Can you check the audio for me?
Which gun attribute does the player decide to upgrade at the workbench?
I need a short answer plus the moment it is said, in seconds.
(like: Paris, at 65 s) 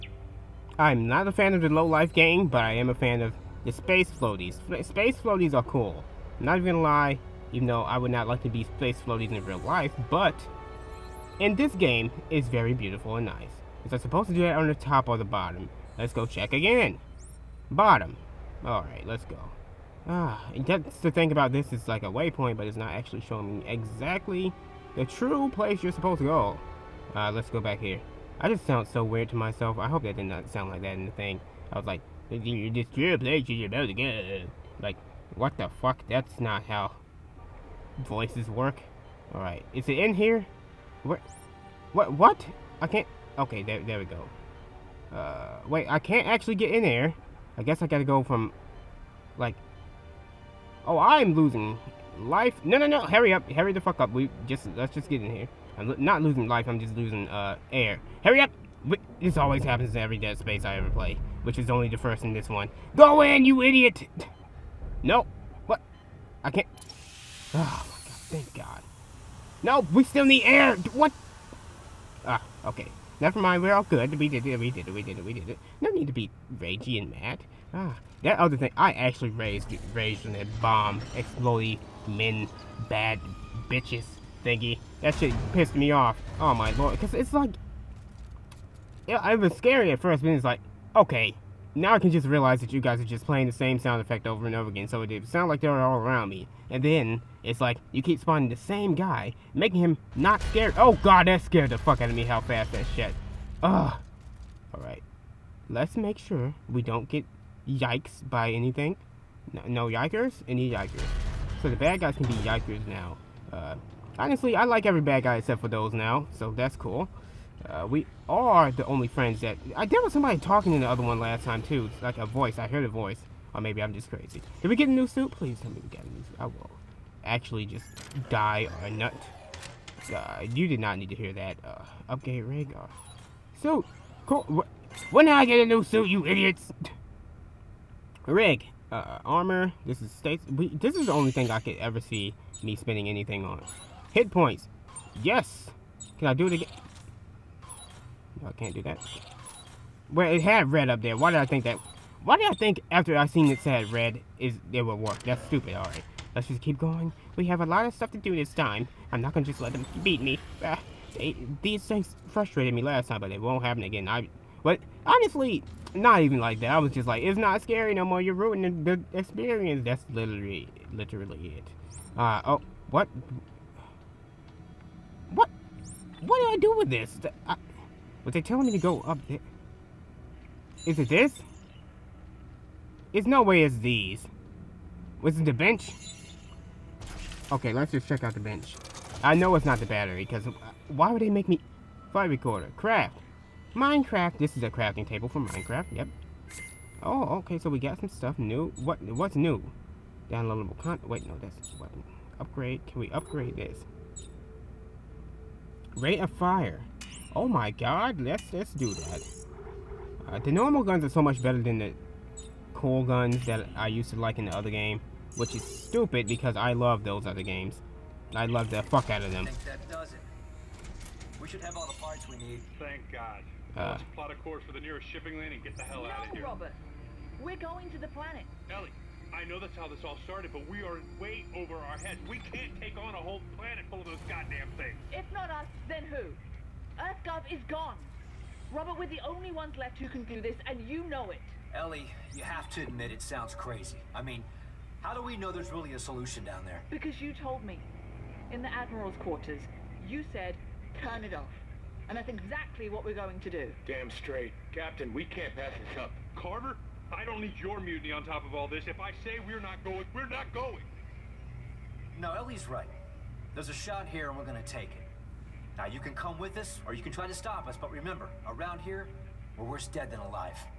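Rate of fire, at 205 s.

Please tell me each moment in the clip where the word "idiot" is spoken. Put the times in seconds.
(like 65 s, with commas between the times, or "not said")
63 s, 136 s.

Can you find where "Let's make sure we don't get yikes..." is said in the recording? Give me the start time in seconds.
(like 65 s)
105 s.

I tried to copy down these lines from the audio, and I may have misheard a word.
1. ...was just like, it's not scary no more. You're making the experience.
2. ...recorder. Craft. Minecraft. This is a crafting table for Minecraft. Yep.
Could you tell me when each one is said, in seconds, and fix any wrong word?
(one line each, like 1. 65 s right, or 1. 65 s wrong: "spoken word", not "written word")
1. 166 s wrong: "ruining", not "making"
2. 192 s right.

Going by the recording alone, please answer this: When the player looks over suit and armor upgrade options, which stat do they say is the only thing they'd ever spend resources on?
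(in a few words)
Hit points.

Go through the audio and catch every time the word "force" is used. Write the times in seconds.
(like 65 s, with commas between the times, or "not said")
not said.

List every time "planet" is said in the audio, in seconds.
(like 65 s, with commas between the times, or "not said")
228 s, 233 s.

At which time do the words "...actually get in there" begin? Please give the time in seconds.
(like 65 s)
46 s.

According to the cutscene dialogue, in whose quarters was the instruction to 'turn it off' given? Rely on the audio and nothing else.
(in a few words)
The Admiral's quarters.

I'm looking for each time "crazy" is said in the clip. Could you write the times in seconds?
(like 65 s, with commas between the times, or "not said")
124 s, 243 s.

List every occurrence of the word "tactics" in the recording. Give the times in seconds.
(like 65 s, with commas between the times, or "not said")
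not said.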